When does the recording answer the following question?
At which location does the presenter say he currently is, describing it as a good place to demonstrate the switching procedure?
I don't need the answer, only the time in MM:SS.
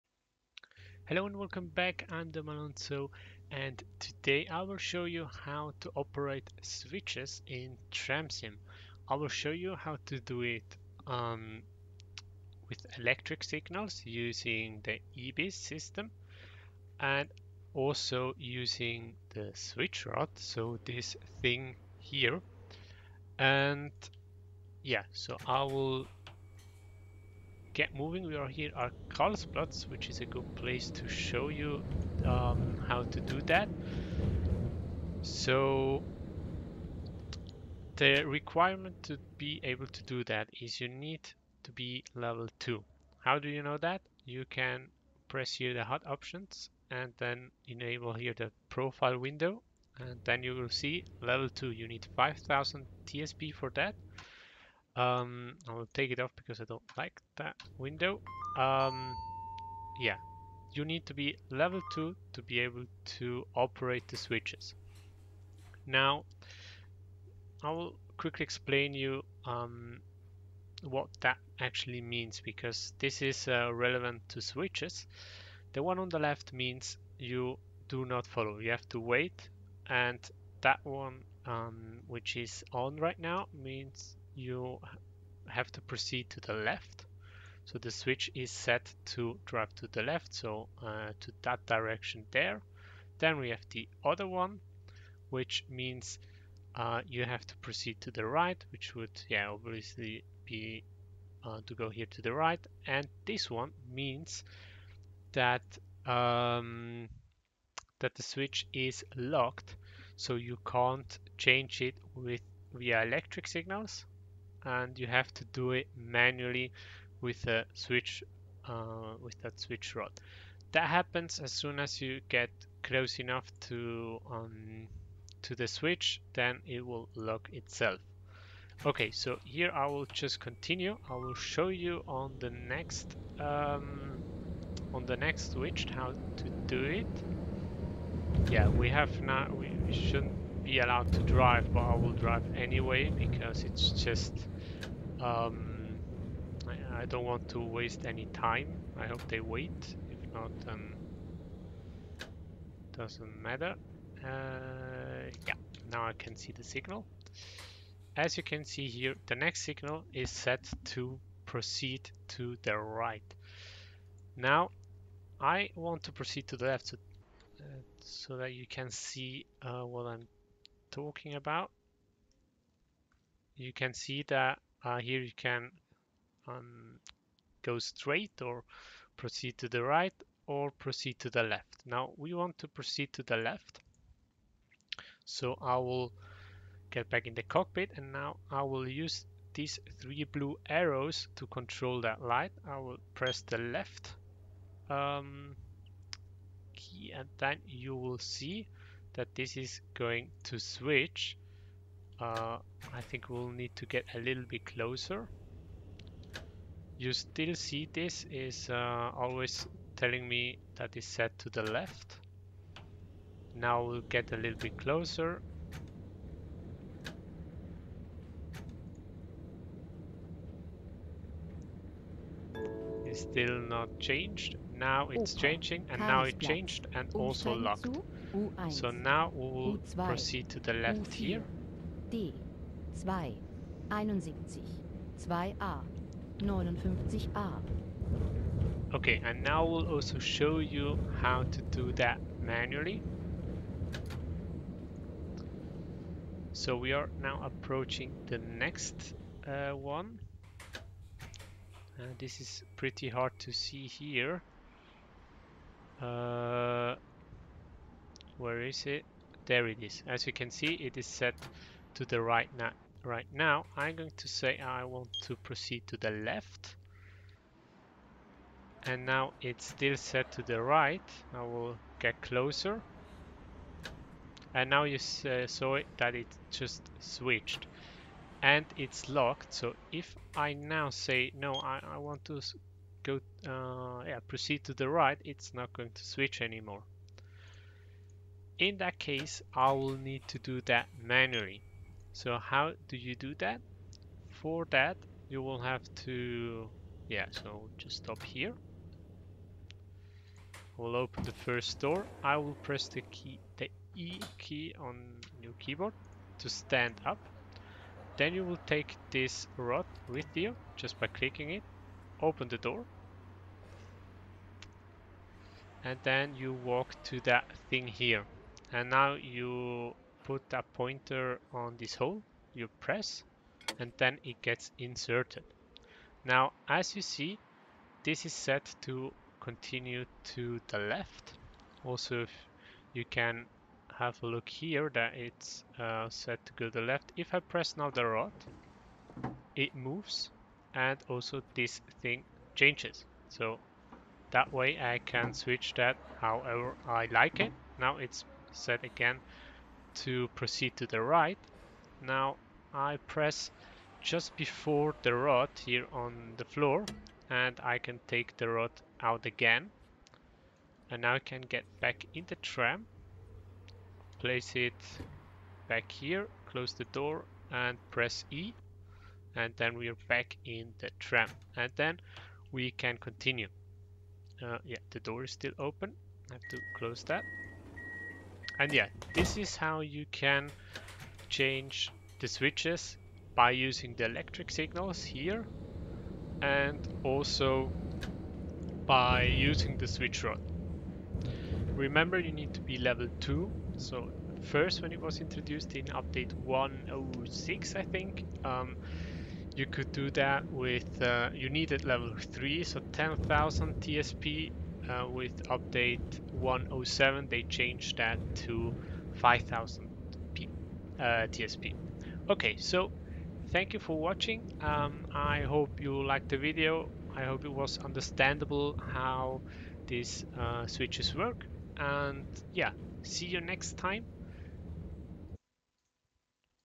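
00:29.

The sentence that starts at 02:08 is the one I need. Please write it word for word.
Okay, so here I will just continue.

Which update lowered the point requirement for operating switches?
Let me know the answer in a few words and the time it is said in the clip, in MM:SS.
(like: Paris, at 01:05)
Update 107, at 06:45.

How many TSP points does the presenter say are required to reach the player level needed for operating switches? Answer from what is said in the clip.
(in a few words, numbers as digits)
5000.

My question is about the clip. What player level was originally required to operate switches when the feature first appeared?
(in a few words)
Level 3.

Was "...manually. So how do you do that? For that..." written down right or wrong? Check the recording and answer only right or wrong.
right.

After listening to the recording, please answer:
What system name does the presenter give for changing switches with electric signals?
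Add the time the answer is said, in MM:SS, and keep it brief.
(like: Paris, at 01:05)
EBIS, at 00:15.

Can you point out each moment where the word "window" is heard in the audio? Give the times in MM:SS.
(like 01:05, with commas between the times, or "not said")
00:49, 00:57.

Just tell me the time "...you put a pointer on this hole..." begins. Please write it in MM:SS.
05:19.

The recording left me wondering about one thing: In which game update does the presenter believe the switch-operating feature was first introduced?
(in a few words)
Update 106.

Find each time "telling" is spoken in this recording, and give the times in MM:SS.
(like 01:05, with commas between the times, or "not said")
03:29.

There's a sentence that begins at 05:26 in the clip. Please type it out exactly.
Now, as you see, this is set to continue to the left.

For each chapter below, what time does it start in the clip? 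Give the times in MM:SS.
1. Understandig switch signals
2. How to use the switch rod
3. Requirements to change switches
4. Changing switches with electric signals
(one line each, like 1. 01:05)
1. 01:03
2. 03:58
3. 00:36
4. 02:35.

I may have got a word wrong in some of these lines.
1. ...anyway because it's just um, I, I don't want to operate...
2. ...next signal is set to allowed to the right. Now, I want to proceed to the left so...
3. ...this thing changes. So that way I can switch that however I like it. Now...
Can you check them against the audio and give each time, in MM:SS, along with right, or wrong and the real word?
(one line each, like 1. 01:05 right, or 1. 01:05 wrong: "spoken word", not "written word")
1. 02:22 wrong: "waste", not "operate"
2. 02:39 wrong: "proceed", not "allowed"
3. 05:41 right.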